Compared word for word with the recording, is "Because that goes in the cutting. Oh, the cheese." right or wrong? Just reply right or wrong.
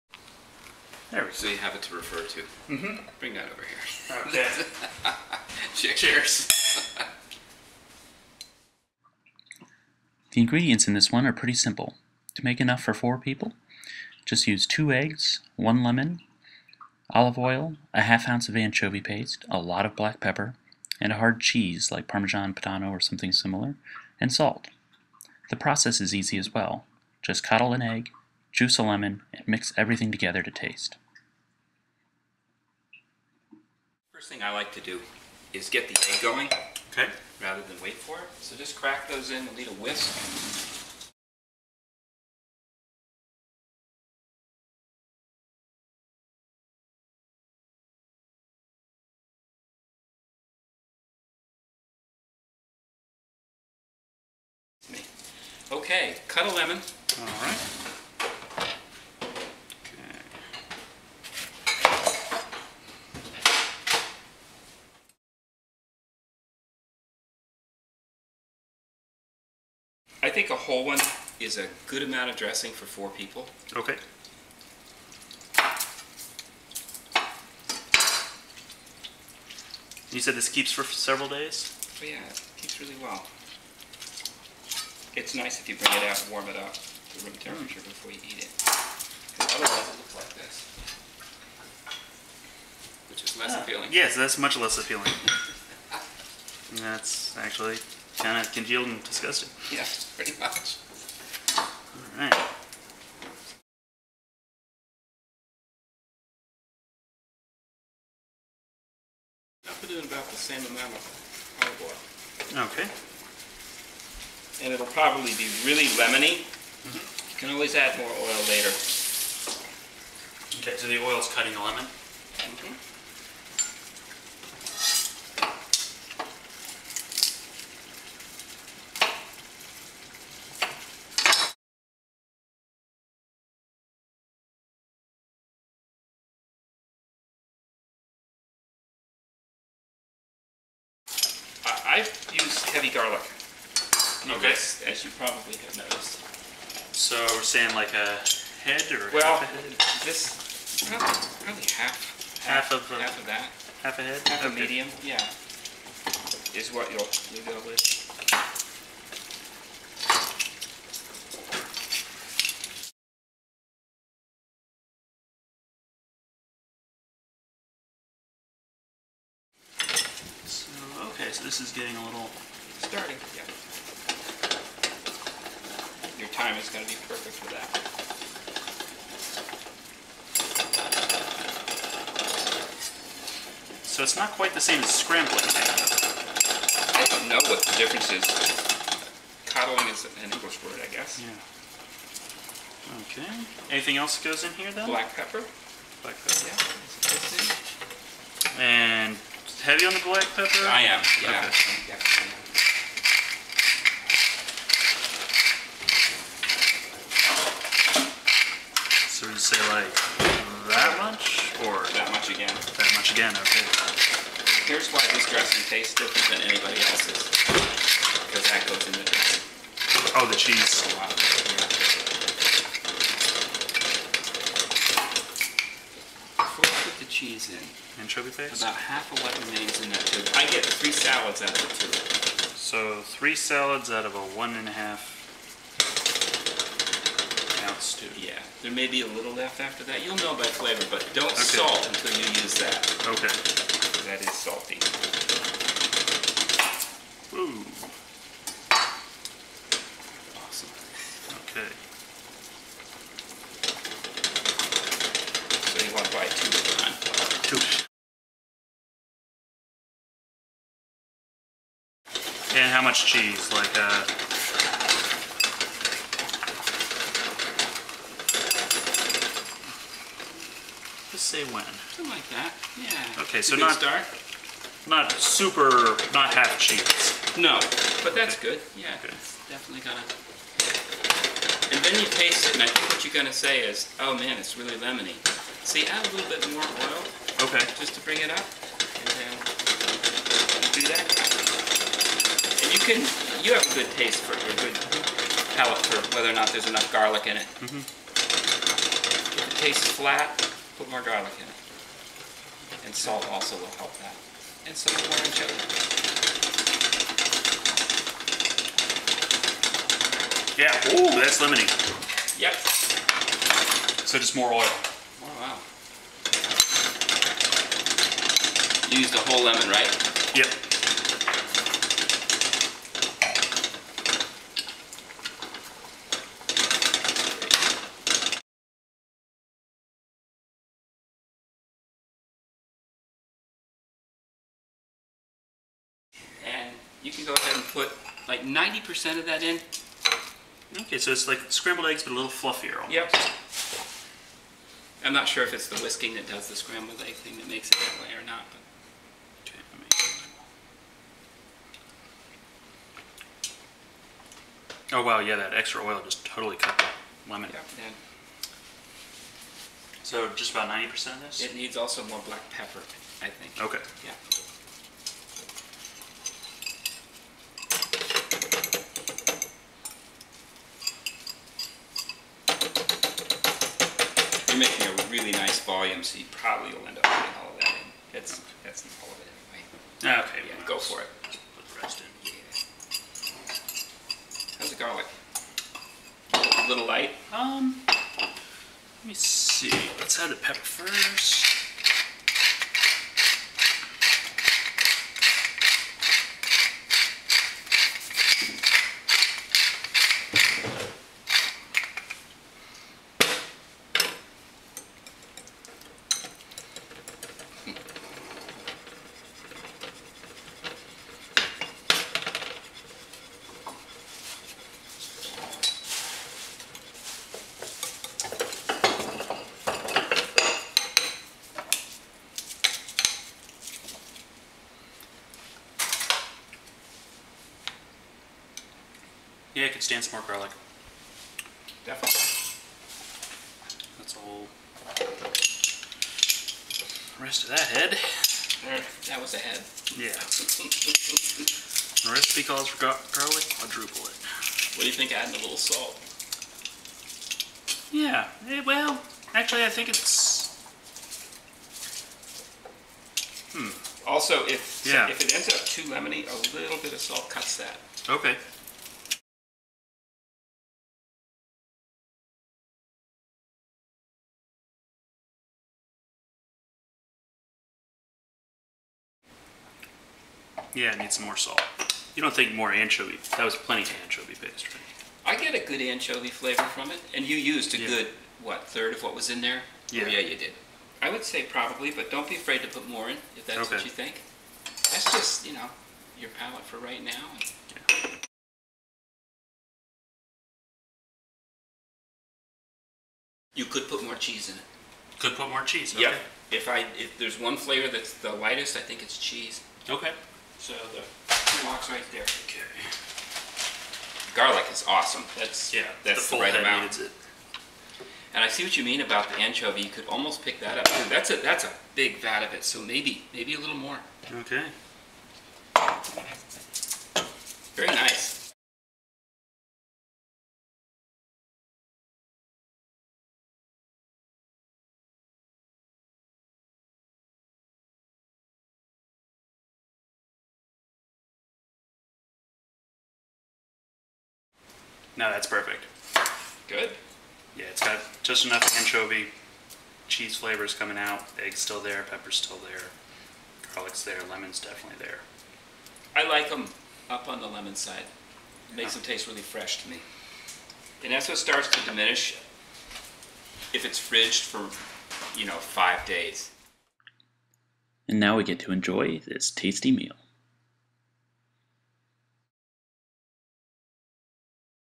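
wrong.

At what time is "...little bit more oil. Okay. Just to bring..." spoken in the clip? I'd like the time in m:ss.
4:46.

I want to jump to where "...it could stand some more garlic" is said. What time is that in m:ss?
7:09.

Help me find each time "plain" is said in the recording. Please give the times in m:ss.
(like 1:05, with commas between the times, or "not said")
not said.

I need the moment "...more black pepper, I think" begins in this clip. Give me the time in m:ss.
6:02.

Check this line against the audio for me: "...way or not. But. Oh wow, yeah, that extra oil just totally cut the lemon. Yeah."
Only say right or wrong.
right.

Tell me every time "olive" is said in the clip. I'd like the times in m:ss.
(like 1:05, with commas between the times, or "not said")
0:17, 1:51.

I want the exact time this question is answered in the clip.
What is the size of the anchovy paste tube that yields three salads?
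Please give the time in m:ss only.
3:54.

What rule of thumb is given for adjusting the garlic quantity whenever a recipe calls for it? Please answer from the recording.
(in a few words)
quadruple it.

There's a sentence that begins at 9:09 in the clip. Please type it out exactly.
them taste really fresh to me.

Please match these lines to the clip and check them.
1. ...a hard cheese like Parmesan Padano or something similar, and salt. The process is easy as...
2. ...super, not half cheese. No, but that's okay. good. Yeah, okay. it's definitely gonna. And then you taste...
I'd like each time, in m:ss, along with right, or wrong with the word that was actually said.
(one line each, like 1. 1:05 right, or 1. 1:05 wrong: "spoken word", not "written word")
1. 0:21 right
2. 4:35 right.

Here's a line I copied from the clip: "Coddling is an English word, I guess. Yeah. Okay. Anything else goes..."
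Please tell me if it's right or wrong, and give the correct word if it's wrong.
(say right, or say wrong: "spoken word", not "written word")
right.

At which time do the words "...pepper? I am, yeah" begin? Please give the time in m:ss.
3:20.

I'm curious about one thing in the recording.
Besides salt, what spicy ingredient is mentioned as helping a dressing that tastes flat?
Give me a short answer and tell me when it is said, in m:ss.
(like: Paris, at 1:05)
orange chili, at 5:05.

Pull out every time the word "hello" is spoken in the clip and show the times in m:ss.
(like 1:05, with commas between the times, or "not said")
not said.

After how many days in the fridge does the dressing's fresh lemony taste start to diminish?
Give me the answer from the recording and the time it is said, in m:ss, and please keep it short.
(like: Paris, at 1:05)
5, at 9:15.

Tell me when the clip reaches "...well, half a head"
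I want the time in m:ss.
2:29.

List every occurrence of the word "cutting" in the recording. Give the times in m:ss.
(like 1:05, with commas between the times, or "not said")
2:01.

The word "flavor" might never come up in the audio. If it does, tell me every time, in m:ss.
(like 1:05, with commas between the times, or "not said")
4:00, 7:56, 8:17, 9:00.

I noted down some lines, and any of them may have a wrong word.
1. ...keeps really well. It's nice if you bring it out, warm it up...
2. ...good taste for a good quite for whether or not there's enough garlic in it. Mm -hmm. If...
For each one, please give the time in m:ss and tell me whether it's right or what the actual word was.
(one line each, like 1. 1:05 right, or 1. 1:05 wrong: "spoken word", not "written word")
1. 1:22 right
2. 4:53 wrong: "palate", not "quite".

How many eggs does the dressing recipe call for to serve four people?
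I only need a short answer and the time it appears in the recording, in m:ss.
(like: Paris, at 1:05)
2, at 0:14.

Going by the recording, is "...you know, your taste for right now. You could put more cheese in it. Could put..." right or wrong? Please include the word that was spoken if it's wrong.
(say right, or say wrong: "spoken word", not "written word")
wrong: "palate", not "taste".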